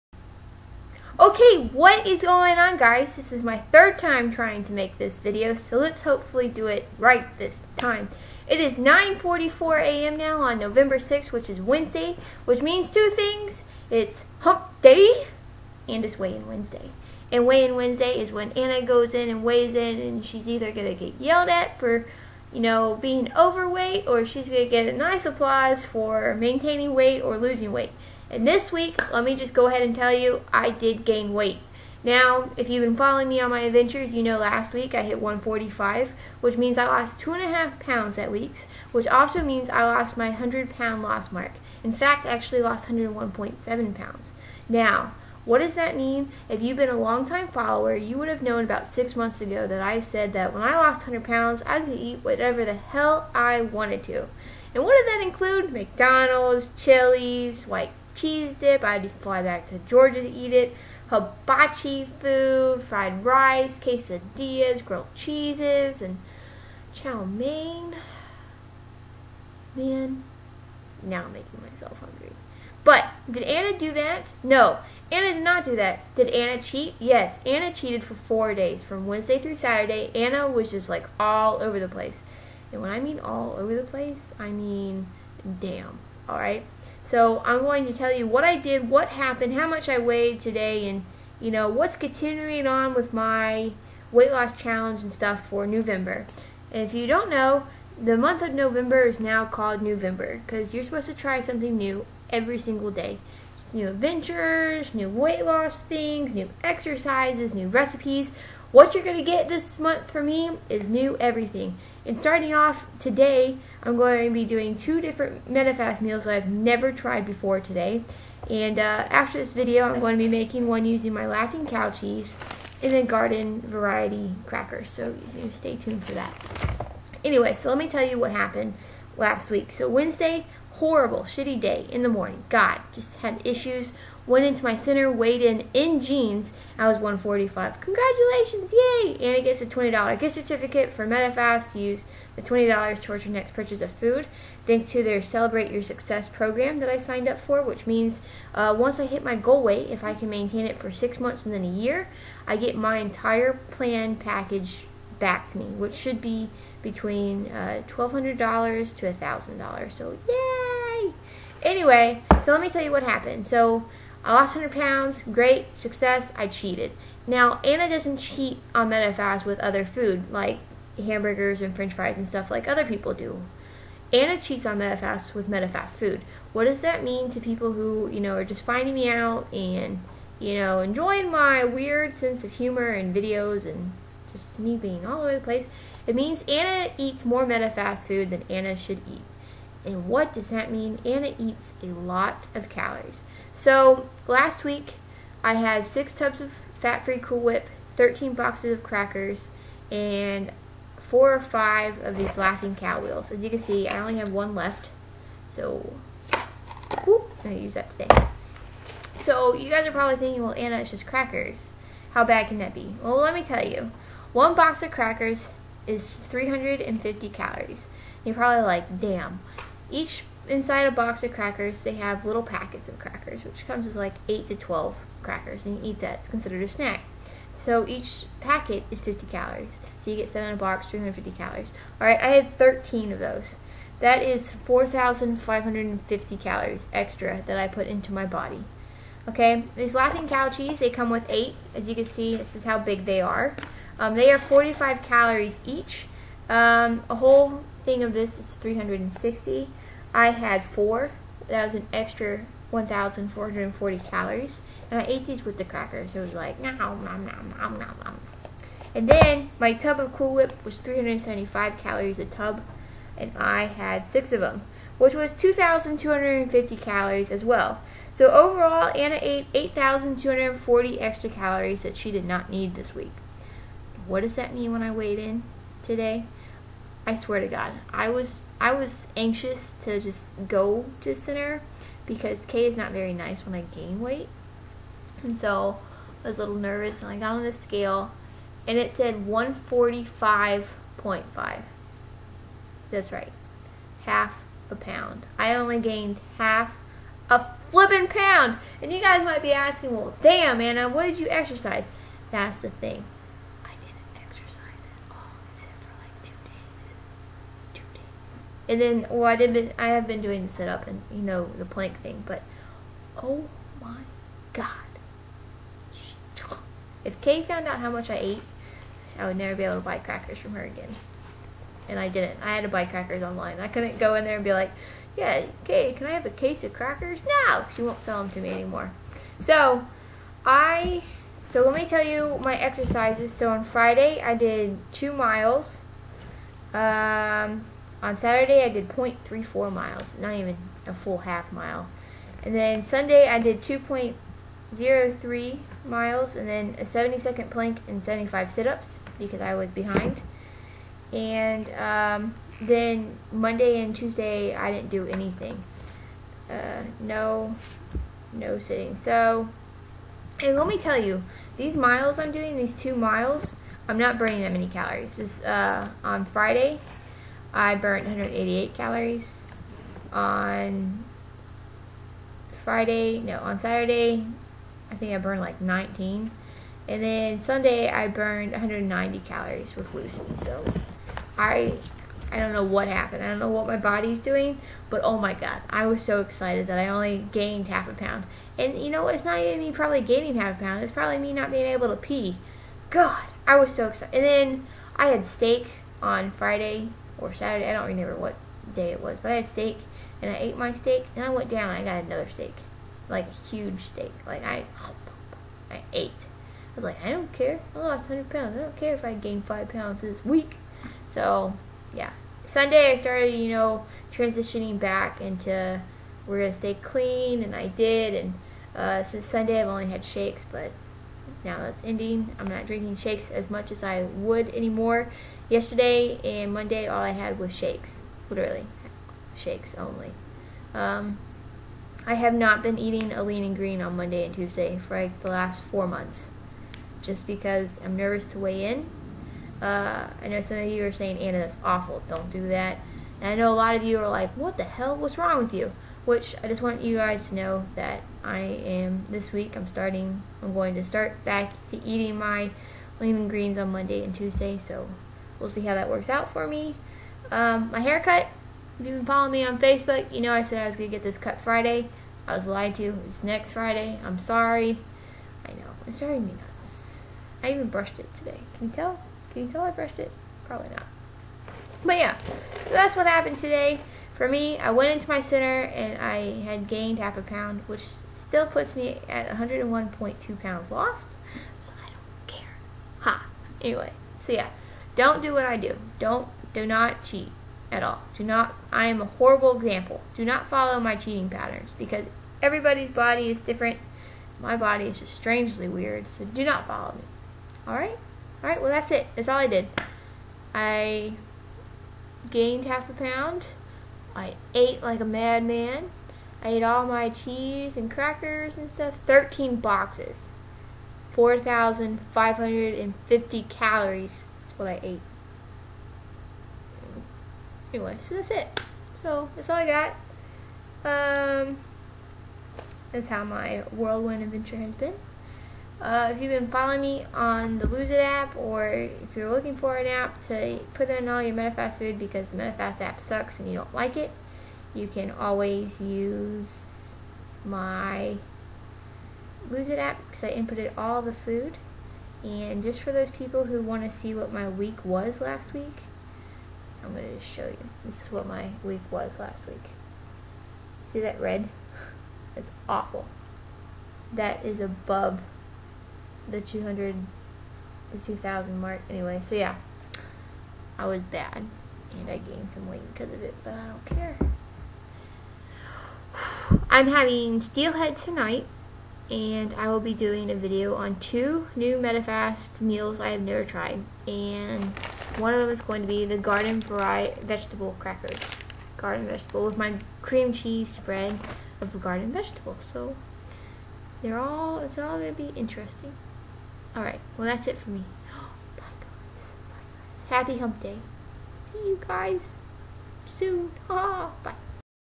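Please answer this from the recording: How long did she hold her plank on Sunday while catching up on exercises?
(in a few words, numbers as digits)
70 seconds.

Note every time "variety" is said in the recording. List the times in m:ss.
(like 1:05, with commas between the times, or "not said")
2:03, 9:36.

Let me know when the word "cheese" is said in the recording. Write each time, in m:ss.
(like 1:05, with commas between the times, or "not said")
0:58, 1:05, 2:01, 4:00, 8:27, 9:40.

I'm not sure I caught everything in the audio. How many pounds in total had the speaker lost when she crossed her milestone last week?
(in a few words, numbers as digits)
101.7.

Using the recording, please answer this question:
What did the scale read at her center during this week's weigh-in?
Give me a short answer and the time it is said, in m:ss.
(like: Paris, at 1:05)
145.5, at 4:49.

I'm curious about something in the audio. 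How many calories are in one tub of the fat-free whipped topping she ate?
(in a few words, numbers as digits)
375.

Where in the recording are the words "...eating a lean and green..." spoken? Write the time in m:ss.
7:12.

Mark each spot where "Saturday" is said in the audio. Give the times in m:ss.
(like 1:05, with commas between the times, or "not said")
1:19, 5:38, 6:13, 6:37.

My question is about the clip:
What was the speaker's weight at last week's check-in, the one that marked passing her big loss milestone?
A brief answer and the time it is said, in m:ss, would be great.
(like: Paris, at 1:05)
145, at 0:34.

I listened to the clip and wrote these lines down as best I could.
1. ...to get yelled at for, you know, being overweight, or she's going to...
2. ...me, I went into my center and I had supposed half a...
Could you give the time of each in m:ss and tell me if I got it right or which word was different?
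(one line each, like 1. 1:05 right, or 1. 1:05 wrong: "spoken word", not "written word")
1. 0:20 right
2. 7:54 wrong: "gained", not "supposed".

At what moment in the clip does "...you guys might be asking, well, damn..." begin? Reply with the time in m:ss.
4:58.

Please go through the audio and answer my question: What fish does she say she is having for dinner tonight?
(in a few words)
Steelhead.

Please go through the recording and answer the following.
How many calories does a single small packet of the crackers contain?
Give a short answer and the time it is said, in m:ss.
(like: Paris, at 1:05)
50, at 3:49.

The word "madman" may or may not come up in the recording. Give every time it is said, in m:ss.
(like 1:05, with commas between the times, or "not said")
8:25.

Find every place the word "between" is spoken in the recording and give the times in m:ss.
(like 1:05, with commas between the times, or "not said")
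2:36.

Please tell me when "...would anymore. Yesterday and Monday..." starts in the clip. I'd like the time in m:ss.
7:04.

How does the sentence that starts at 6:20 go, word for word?
So I I don't know what happened.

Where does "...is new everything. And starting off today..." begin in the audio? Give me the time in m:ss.
1:50.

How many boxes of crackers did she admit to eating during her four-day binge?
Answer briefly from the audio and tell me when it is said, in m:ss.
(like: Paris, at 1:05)
13, at 3:17.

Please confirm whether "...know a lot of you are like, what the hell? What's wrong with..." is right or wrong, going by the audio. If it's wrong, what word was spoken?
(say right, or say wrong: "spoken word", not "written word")
right.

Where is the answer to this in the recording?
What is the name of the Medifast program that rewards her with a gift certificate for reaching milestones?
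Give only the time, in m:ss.
2:25.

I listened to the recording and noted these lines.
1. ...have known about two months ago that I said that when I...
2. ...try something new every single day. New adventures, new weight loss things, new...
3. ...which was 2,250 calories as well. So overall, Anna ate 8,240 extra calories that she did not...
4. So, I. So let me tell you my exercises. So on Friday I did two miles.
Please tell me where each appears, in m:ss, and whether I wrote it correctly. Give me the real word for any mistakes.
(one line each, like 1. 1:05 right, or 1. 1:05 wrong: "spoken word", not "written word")
1. 0:48 wrong: "six", not "two"
2. 1:41 right
3. 4:24 right
4. 5:29 right.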